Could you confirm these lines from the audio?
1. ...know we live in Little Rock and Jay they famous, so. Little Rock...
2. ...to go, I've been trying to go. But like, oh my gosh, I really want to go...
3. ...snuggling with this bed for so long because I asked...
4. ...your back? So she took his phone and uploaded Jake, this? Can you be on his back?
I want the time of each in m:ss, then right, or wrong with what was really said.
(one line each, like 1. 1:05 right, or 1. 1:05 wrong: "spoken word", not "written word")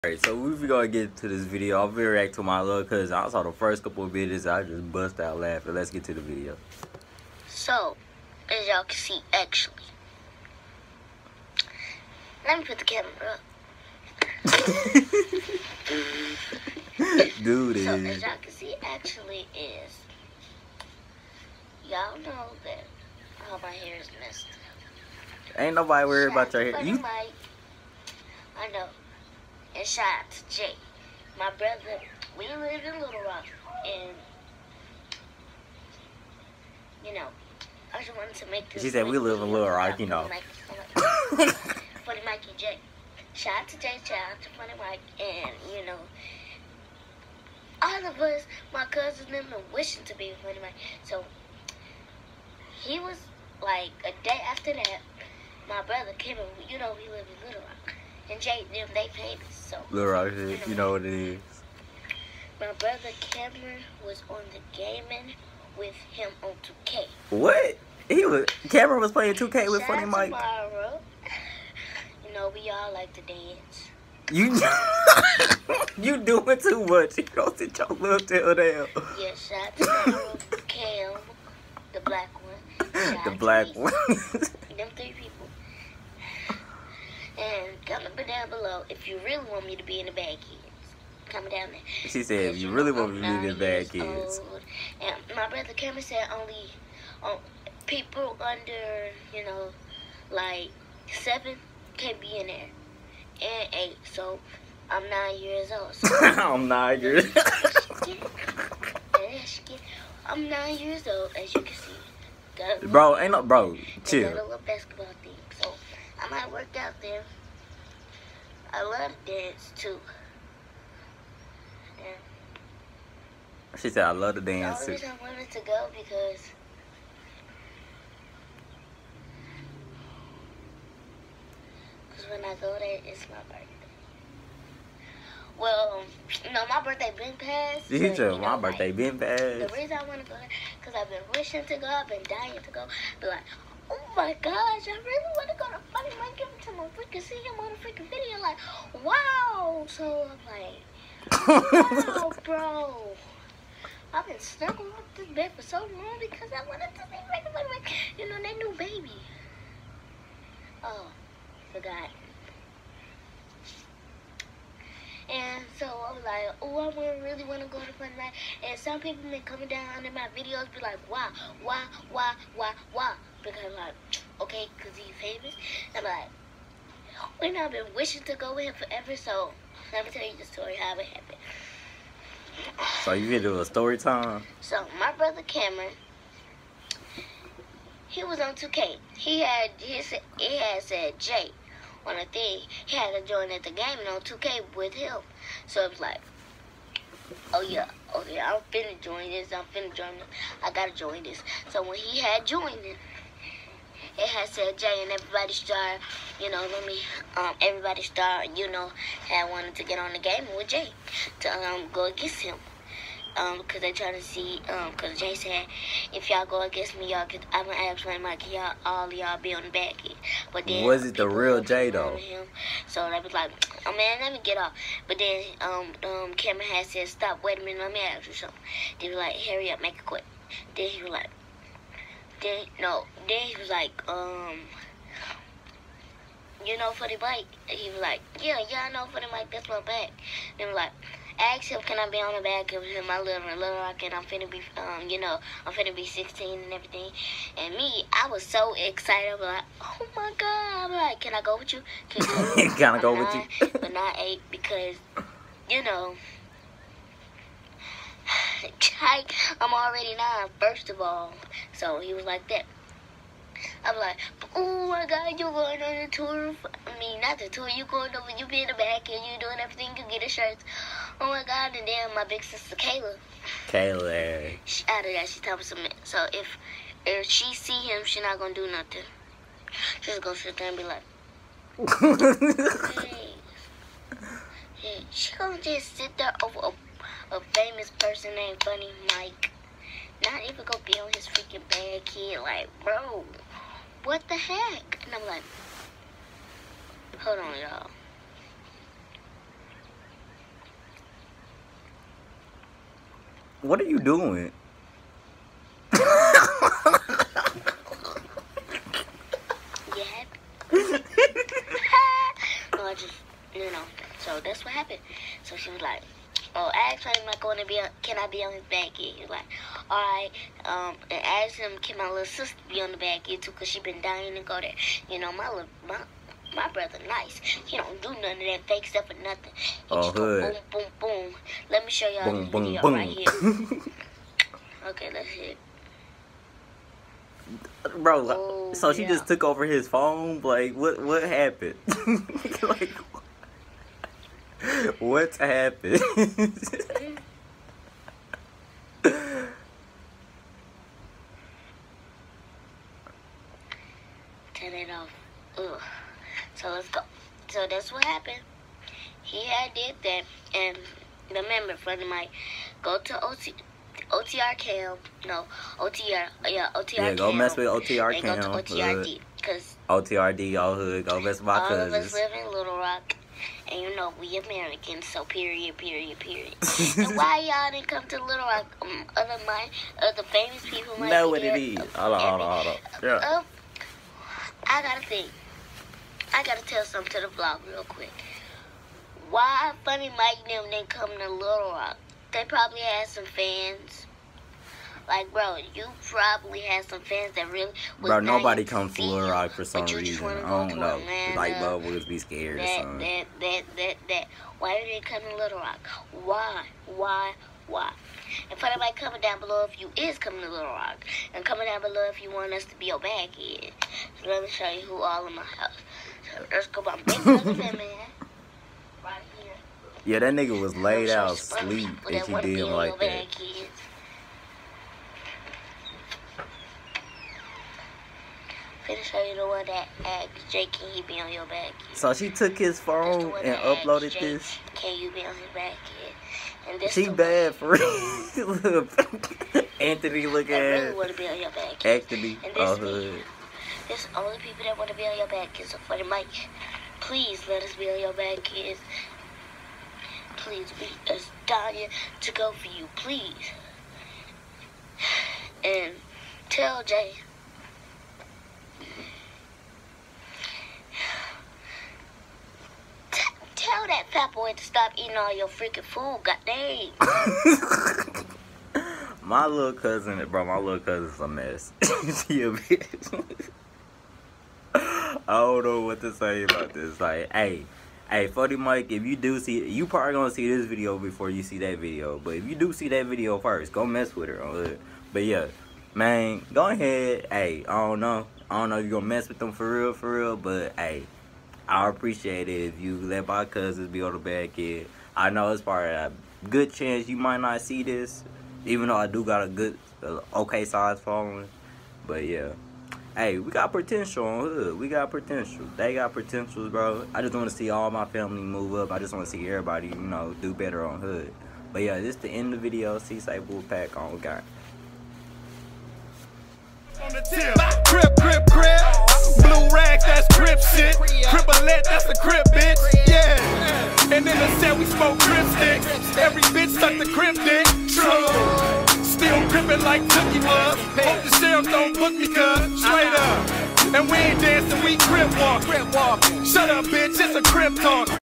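1. 0:56 right
2. 2:21 wrong: "dying", not "trying"
3. 2:34 wrong: "wanted", not "asked"
4. 7:11 right.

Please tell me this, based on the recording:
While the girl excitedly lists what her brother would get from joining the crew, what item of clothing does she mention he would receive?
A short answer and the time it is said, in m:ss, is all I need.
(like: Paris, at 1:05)
a shirt, at 4:30.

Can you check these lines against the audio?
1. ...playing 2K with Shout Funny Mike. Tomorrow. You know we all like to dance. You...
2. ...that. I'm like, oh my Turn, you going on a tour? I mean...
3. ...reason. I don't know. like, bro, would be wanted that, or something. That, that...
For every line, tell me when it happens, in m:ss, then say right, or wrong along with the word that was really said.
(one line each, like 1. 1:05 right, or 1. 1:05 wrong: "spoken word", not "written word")
1. 1:09 right
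2. 4:22 wrong: "God", not "Turn"
3. 6:39 wrong: "scared", not "wanted".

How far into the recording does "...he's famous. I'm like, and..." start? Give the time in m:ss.
2:54.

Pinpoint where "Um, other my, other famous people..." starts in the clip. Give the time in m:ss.
6:18.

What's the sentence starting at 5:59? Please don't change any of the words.
He had did that, and the member friend of mine go to OT.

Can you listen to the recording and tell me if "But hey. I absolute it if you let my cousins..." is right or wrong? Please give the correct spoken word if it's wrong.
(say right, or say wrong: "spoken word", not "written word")
wrong: "appreciate", not "absolute".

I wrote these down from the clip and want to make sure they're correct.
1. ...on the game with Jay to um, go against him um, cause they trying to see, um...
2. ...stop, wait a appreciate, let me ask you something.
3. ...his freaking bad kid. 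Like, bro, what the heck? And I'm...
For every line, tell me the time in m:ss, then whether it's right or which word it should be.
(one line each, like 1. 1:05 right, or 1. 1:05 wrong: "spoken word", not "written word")
1. 3:29 right
2. 3:47 wrong: "minute", not "appreciate"
3. 4:51 right.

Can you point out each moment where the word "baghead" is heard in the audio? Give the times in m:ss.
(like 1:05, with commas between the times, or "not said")
6:52.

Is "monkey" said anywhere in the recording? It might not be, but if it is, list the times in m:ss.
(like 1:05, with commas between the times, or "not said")
2:26, 3:38.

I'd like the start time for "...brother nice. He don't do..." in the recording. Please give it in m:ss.
5:26.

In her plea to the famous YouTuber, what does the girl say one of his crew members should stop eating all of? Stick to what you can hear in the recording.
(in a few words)
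food.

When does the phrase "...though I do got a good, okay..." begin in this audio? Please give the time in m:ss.
8:18.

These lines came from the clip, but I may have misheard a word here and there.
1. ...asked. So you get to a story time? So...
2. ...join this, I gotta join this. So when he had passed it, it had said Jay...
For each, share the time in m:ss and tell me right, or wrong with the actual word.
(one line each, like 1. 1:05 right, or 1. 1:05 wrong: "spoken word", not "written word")
1. 3:01 wrong: "happened", not "asked"
2. 3:19 wrong: "joined", not "passed".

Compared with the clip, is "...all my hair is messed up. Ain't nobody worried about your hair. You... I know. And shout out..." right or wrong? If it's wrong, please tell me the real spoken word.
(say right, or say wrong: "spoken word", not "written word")
right.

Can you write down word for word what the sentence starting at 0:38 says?
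She said we live in Little Rock, you know.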